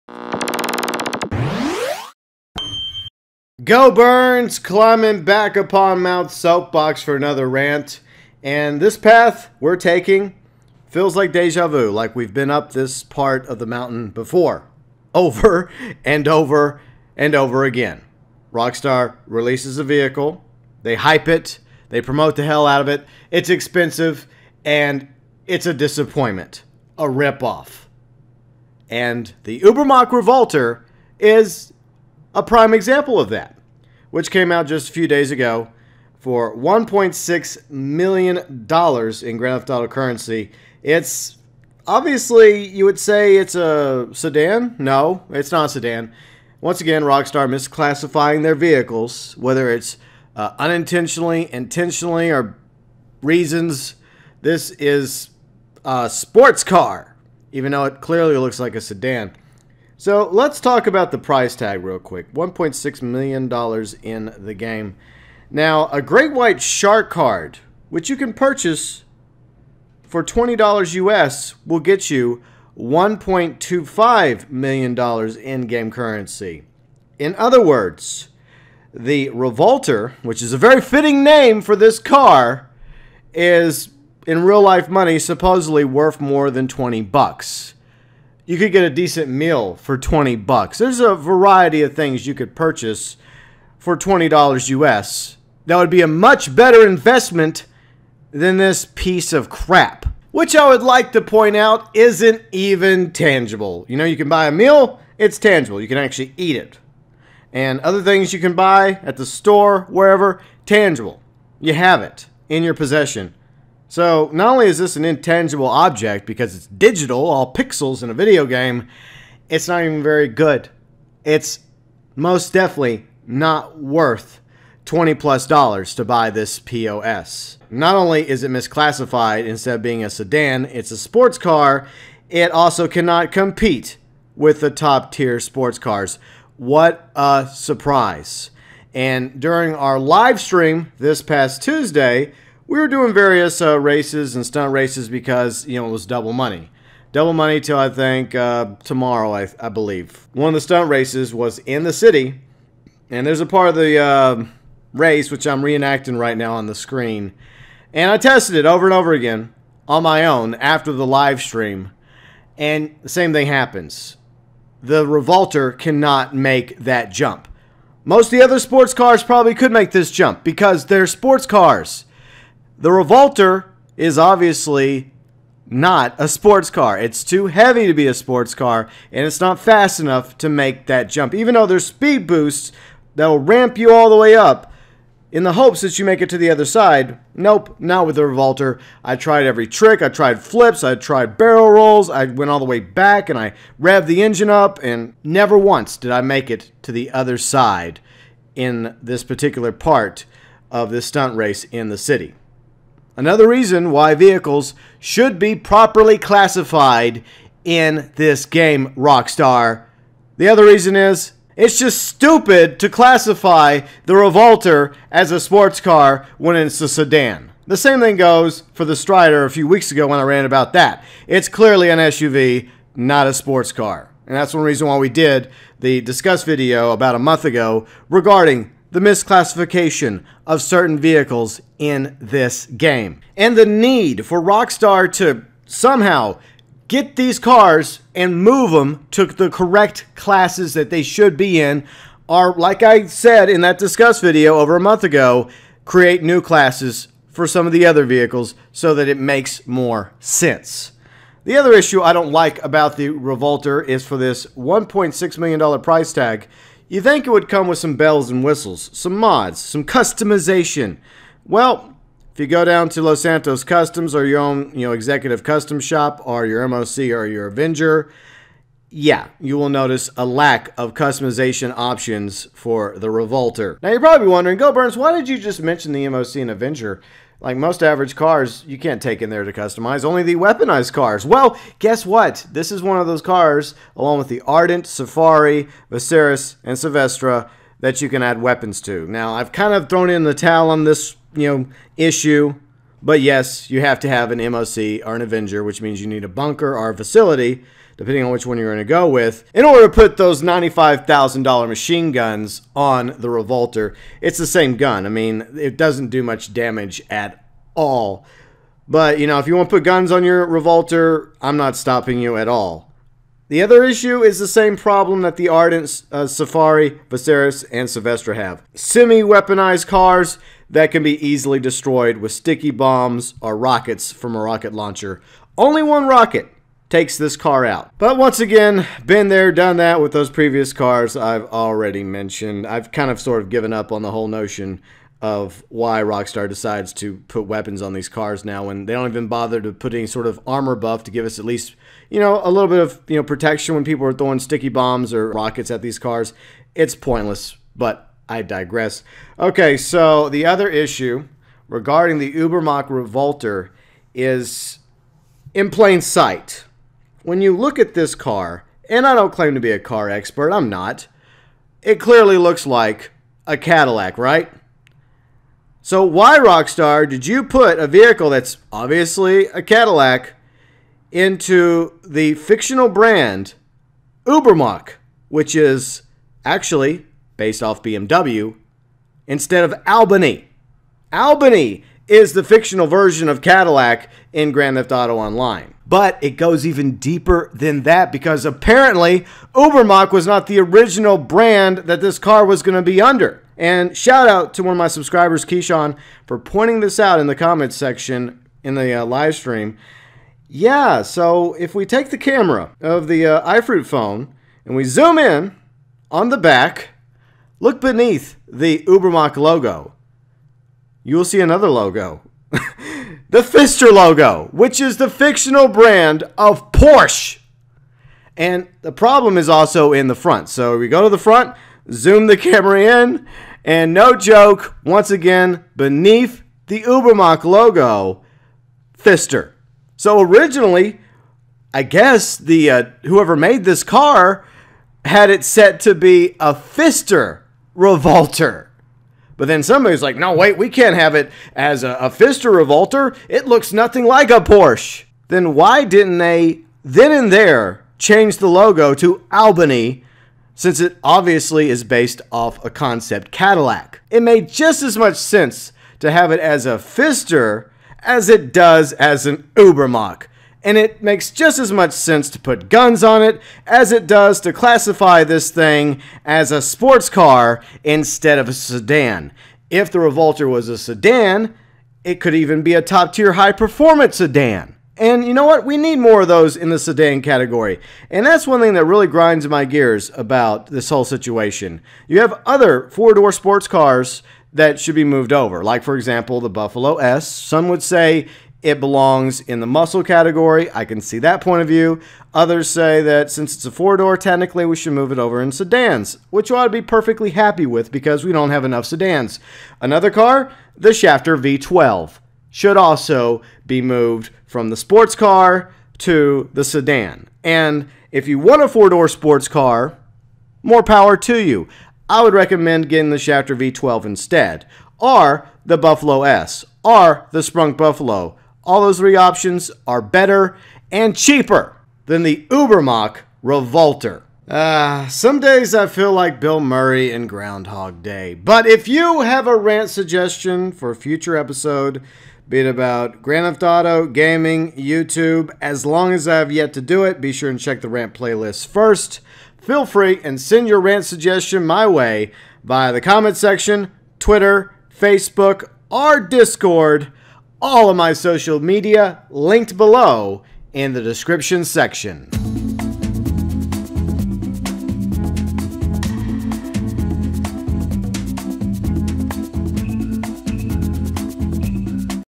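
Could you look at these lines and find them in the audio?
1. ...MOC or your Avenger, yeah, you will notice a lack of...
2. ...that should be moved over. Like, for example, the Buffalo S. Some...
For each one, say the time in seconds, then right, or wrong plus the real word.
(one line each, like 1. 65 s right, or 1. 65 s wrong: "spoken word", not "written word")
1. 266 s right
2. 484 s right.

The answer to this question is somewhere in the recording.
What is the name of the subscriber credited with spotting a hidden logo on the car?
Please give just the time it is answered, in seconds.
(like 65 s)
395 s.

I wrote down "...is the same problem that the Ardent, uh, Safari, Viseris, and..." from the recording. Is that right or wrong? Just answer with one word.
right.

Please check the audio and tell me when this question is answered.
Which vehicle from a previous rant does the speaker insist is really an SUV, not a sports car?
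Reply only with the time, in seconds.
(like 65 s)
218 s.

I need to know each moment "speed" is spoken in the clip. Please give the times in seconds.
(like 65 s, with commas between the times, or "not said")
181 s.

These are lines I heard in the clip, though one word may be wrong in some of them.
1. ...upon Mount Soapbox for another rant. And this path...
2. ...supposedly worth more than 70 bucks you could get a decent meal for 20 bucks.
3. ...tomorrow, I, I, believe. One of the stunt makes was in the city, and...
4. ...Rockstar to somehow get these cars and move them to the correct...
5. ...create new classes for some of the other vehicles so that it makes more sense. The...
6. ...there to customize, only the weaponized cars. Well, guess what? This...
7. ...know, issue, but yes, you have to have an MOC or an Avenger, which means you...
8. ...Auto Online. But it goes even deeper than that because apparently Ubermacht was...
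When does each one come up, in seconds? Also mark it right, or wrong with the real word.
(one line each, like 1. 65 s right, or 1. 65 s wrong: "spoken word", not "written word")
1. 5 s right
2. 85 s wrong: "20", not "70"
3. 148 s wrong: "races", not "makes"
4. 234 s right
5. 245 s right
6. 279 s right
7. 291 s right
8. 384 s right.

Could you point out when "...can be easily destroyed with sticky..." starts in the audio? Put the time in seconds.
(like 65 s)
320 s.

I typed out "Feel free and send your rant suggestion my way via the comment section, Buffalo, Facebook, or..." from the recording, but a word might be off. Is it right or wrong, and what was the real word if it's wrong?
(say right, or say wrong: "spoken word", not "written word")
wrong: "Twitter", not "Buffalo".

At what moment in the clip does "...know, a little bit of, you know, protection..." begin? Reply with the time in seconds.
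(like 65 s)
342 s.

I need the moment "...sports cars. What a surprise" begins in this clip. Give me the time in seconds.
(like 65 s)
135 s.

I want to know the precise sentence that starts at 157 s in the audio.
And I tested it over and over again on my own after the live stream, and the same thing happens.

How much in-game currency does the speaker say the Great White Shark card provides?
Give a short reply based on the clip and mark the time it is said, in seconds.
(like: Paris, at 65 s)
$1.25 million, at 72 s.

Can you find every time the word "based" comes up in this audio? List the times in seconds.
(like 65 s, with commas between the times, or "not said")
377 s, 451 s.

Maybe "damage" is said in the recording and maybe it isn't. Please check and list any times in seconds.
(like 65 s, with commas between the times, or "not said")
306 s.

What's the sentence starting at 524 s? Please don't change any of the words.
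Uh, some days I feel like Bill Murray in Groundhog Day.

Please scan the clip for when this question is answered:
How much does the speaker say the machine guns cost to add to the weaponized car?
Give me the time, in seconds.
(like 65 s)
300 s.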